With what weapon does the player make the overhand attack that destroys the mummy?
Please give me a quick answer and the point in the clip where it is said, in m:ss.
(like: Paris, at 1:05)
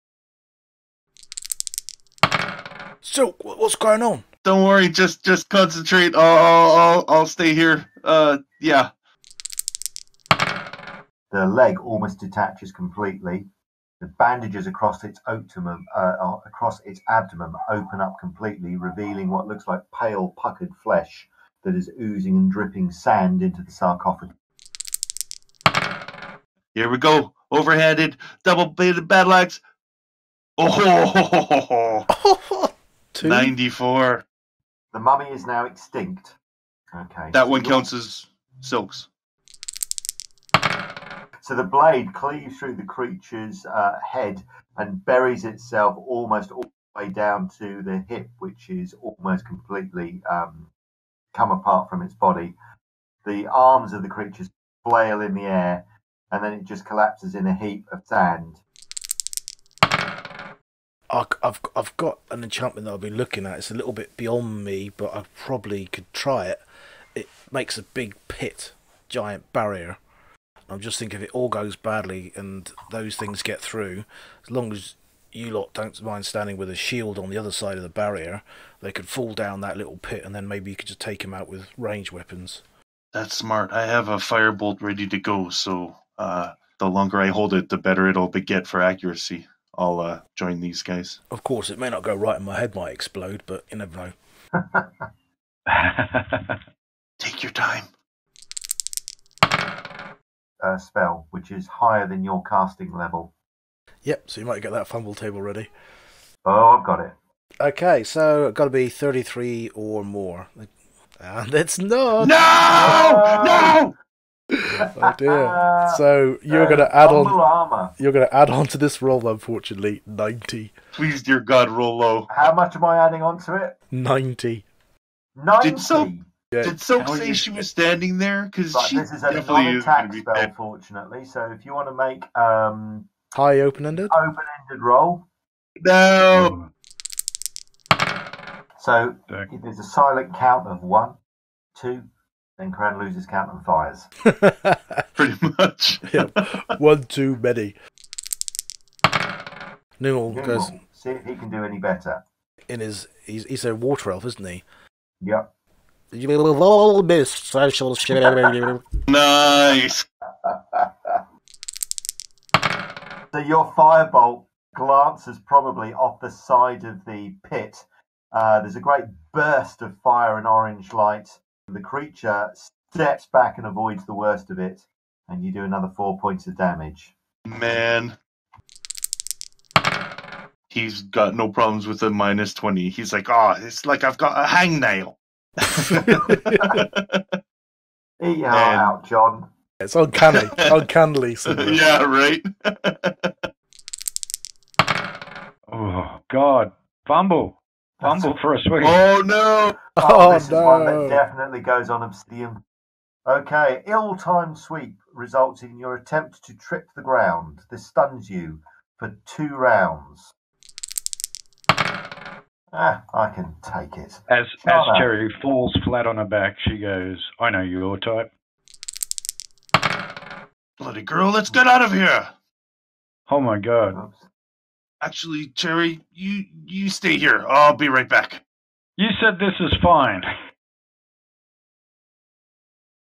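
Double-bladed battle axe, at 0:28.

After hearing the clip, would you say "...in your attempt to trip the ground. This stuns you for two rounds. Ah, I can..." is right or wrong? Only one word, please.
right.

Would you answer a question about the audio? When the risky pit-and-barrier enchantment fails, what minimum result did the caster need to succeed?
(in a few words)
33.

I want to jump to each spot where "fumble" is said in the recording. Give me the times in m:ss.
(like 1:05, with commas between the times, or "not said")
1:44, 3:18.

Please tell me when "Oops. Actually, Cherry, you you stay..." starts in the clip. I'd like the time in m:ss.
3:44.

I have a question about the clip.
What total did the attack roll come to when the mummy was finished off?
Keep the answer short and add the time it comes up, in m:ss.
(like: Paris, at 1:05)
94, at 0:33.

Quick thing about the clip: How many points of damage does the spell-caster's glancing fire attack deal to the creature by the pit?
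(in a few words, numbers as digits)
4.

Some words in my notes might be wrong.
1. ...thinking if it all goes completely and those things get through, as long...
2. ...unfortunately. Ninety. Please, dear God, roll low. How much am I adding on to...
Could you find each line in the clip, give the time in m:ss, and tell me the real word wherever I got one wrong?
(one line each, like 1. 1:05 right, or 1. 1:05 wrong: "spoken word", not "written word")
1. 1:10 wrong: "badly", not "completely"
2. 1:59 right.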